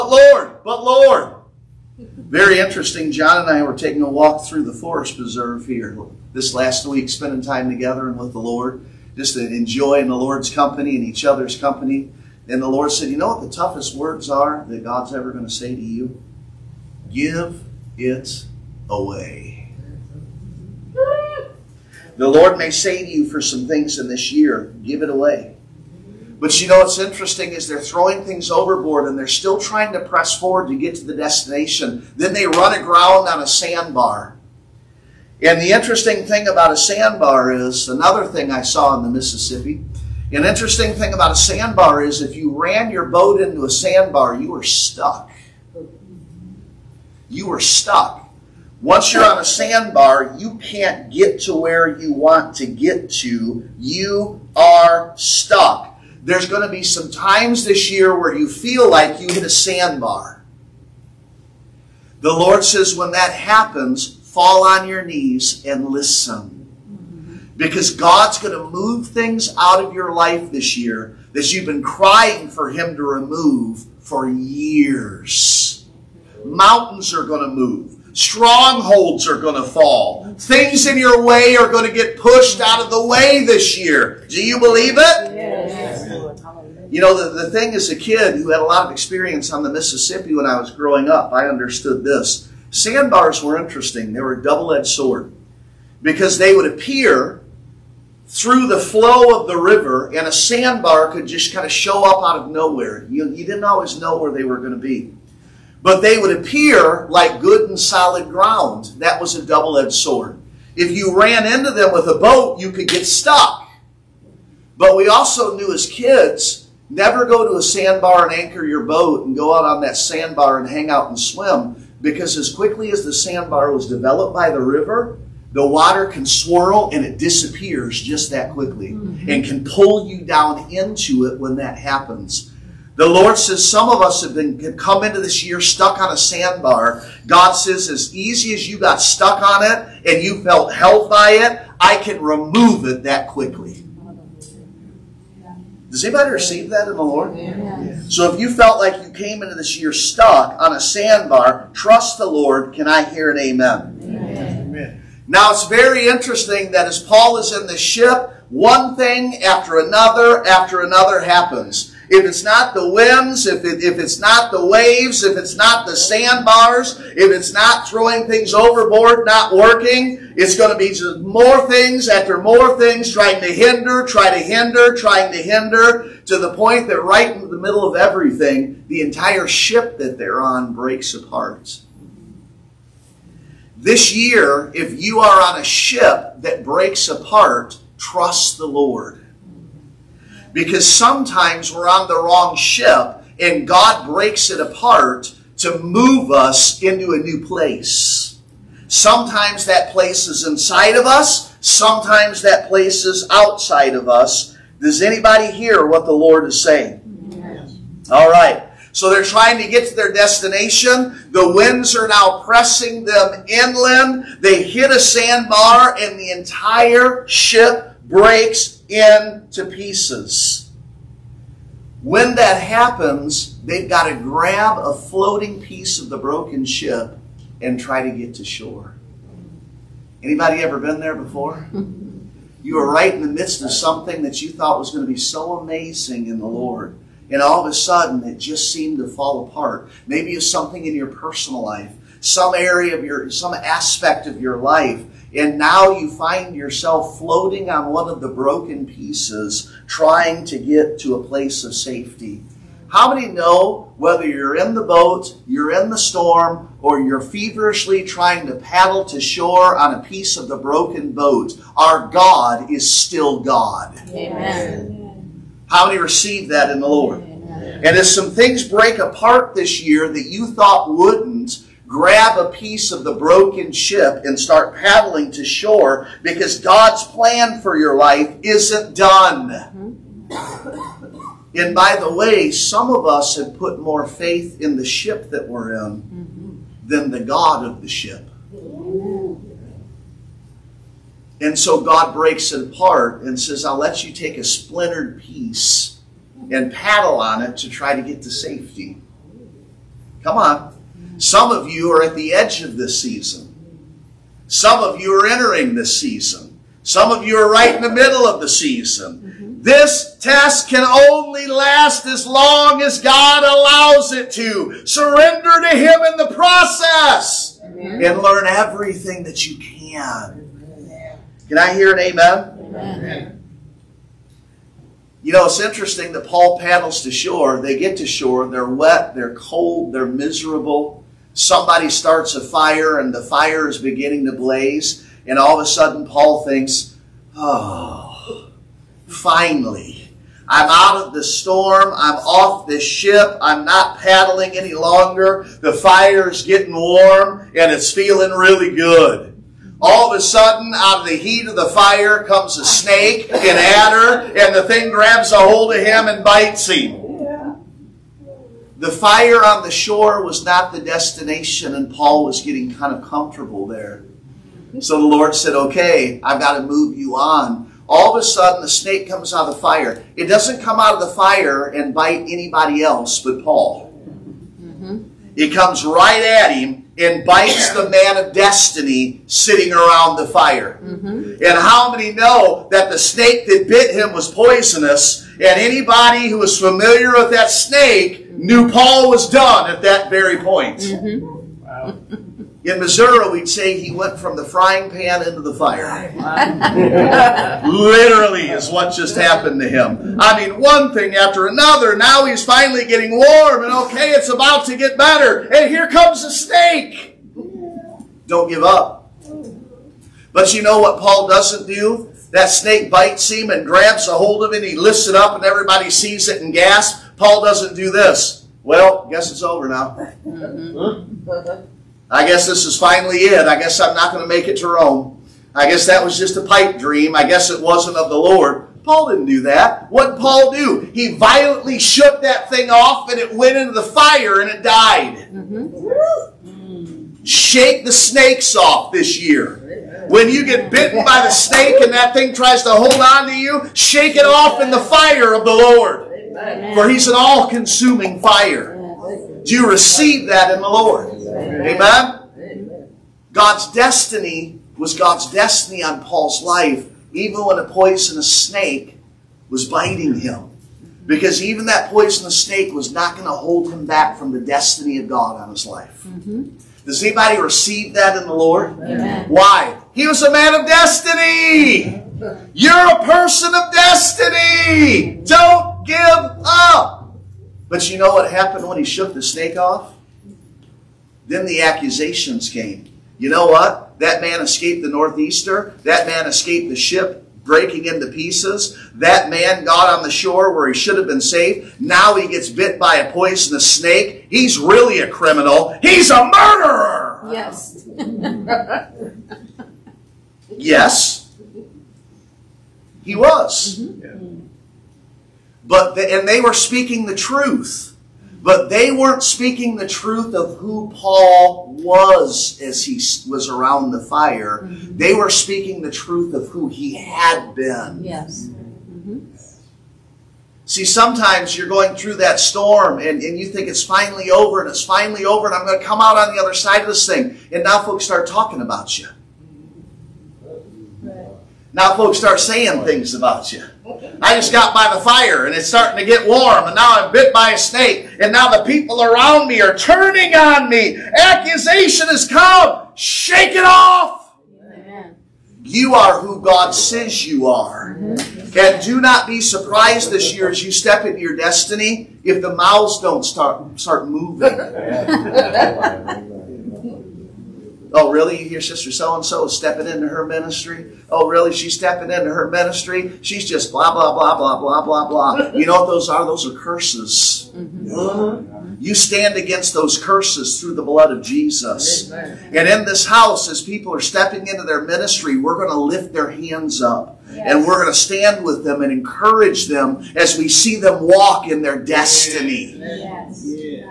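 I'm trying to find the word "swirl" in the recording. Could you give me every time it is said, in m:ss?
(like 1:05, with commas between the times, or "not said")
2:06.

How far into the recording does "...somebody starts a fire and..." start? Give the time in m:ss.
5:31.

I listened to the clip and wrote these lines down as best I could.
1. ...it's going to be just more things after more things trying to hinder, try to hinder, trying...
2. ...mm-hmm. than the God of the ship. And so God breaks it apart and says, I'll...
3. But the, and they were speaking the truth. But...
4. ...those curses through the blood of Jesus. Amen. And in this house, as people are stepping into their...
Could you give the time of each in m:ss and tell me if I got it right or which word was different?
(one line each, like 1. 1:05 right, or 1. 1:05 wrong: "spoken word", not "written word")
1. 2:50 right
2. 4:46 right
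3. 8:25 right
4. 9:29 right.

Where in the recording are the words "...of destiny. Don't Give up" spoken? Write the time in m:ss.
7:53.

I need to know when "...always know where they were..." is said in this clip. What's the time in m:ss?
1:43.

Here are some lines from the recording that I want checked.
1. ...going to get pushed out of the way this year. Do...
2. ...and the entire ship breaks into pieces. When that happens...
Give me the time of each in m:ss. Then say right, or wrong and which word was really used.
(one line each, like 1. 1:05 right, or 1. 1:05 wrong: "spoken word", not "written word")
1. 1:21 right
2. 3:35 right.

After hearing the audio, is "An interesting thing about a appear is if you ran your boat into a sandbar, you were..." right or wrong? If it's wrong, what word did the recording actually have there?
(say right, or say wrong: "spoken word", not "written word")
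wrong: "sandbar", not "appear".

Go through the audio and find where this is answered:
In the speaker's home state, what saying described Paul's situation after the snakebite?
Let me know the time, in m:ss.
6:34.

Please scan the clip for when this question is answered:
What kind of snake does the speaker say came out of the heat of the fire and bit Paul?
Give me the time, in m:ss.
5:53.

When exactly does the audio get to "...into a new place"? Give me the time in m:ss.
3:16.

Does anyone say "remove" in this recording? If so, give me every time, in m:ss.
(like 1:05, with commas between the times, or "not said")
1:13, 2:22.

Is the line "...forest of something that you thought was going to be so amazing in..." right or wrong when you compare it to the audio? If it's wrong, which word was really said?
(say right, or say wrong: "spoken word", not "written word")
wrong: "midst", not "forest".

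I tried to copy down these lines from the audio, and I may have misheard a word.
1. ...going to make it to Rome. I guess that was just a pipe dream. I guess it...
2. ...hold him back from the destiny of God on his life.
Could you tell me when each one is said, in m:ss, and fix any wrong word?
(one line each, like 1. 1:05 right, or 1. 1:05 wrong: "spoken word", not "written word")
1. 7:04 right
2. 7:43 right.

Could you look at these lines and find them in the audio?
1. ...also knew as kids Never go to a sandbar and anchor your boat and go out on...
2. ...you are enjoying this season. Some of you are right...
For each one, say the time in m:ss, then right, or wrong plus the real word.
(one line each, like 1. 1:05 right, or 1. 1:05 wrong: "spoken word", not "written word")
1. 1:55 right
2. 5:05 wrong: "entering", not "enjoying".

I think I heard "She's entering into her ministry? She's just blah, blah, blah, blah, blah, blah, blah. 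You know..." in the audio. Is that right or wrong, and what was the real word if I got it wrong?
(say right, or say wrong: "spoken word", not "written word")
wrong: "stepping", not "entering".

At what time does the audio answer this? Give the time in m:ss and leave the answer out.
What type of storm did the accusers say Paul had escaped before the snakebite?
8:04.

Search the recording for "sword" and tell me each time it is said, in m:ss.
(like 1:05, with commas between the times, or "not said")
1:34, 1:49.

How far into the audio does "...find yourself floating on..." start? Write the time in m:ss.
4:06.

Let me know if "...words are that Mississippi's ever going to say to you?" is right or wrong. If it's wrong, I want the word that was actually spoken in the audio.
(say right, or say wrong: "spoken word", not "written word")
wrong: "God", not "Mississippi".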